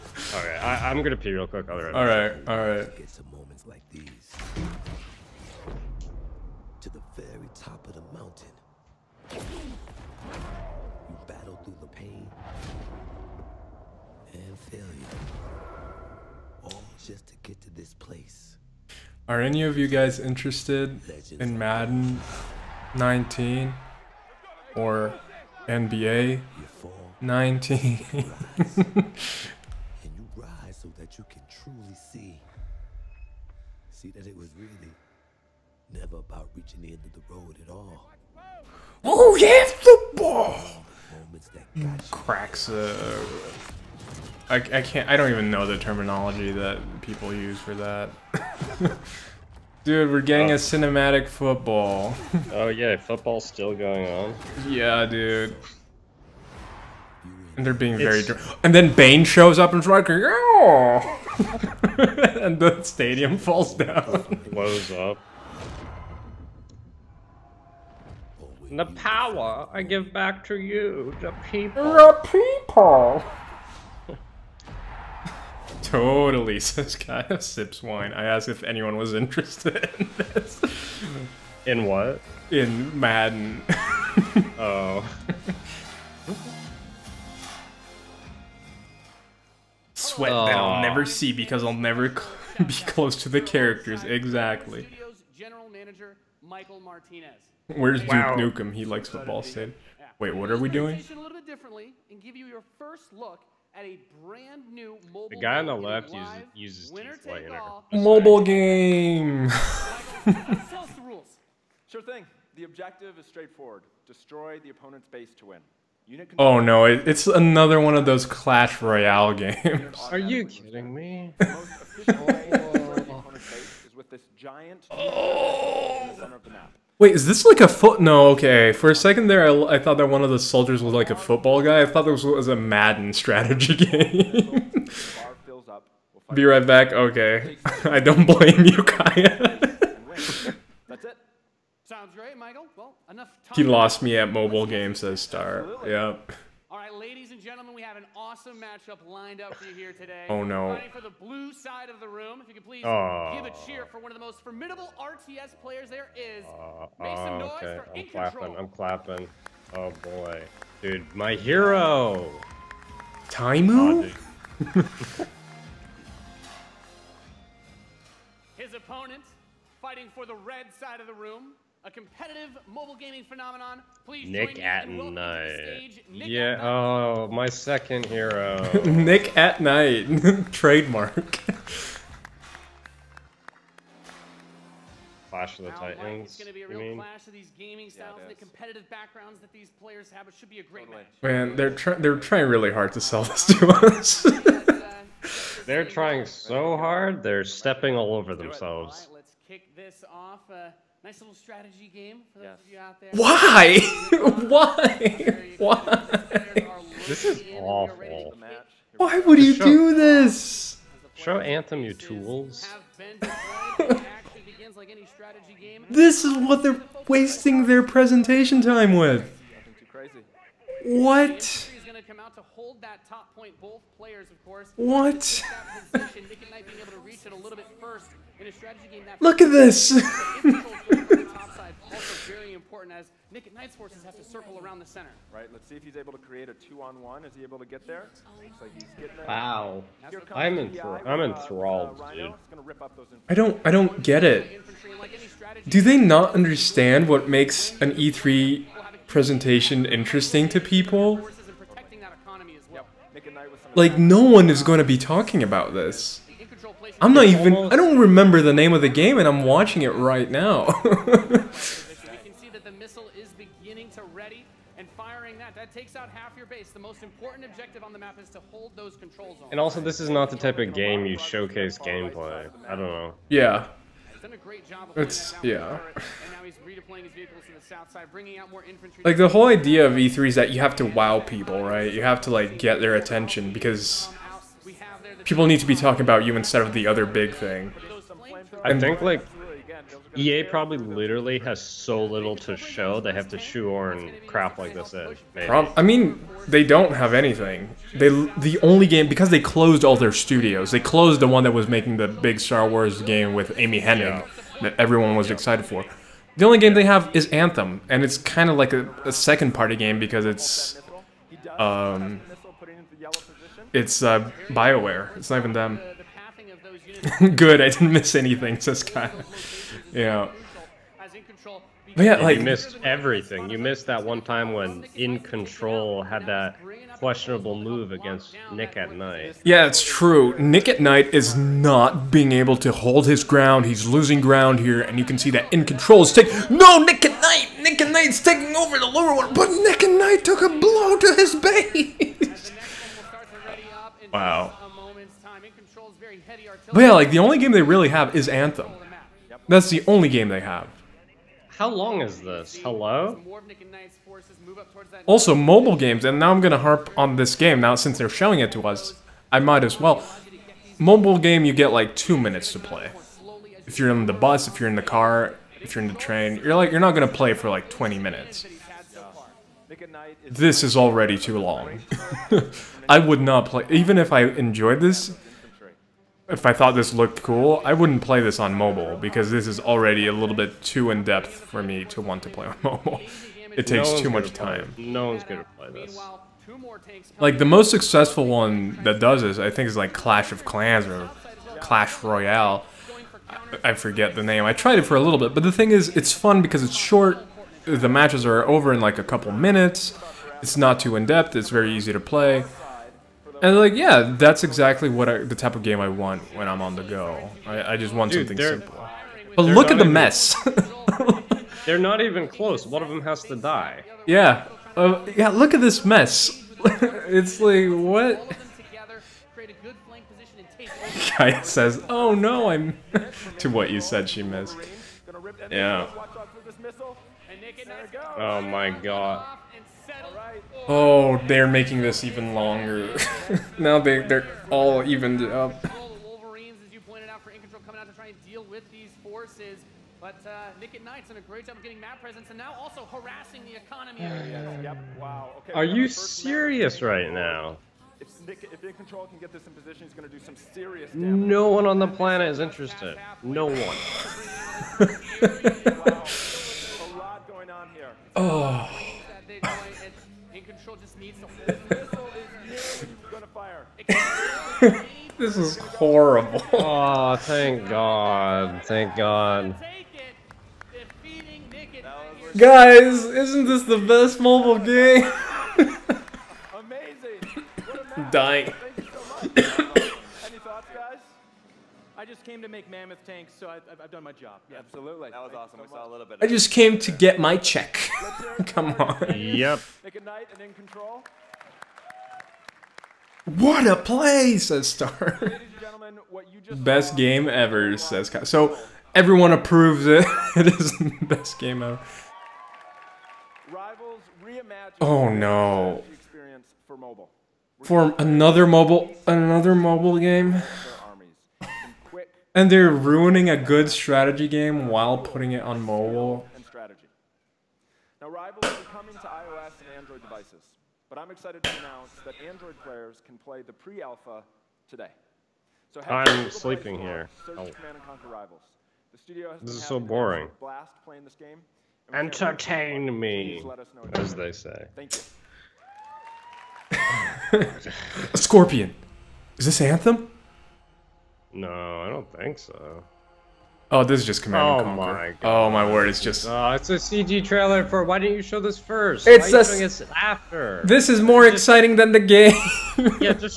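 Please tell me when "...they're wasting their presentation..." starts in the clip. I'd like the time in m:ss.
3:36.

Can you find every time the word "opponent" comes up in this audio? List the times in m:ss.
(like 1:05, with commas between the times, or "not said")
1:54, 2:48.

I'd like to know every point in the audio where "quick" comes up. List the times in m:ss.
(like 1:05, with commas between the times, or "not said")
0:01.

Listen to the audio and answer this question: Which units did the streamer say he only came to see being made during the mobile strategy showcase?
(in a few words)
Mammoth tanks.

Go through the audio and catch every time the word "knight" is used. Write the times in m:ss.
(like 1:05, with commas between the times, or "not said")
3:53, 7:20, 8:09.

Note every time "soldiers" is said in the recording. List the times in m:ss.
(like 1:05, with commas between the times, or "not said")
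2:10.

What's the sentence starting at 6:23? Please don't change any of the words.
It takes no too much time.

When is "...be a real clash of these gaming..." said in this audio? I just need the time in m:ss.
3:06.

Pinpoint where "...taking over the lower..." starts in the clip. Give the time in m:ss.
5:38.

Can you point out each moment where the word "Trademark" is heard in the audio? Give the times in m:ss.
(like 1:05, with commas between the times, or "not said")
3:00.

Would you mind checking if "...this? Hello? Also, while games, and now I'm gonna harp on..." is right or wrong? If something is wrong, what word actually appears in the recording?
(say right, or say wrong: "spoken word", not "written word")
wrong: "mobile", not "while".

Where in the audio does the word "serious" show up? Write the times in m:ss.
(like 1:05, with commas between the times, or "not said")
7:25, 7:30.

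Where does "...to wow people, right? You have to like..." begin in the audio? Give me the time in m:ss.
4:40.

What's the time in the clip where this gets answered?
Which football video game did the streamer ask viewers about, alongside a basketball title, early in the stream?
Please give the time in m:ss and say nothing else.
0:21.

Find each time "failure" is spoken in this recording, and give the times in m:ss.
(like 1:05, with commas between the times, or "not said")
0:14.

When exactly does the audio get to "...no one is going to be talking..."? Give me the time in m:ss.
4:13.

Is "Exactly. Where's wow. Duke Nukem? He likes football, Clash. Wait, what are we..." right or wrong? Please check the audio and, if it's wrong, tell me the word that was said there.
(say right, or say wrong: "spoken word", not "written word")
wrong: "Sid", not "Clash".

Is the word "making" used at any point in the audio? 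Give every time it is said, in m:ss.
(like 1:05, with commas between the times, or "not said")
5:01, 7:11.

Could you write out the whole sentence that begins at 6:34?
I tried it for a little bit, but the thing is, it's fun because it's short.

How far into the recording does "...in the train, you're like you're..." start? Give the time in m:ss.
6:05.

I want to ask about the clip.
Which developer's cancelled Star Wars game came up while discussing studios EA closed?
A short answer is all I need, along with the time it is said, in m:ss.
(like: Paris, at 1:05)
Amy Hennig, at 5:03.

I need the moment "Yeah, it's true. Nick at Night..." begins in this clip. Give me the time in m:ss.
5:29.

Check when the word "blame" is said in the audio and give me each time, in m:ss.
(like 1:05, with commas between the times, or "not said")
2:18.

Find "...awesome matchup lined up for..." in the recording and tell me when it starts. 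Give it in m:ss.
2:28.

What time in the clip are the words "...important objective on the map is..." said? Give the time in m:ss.
4:27.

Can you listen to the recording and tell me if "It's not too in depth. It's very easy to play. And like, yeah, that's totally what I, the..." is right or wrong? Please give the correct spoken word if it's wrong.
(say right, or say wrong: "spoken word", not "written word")
wrong: "exactly", not "totally".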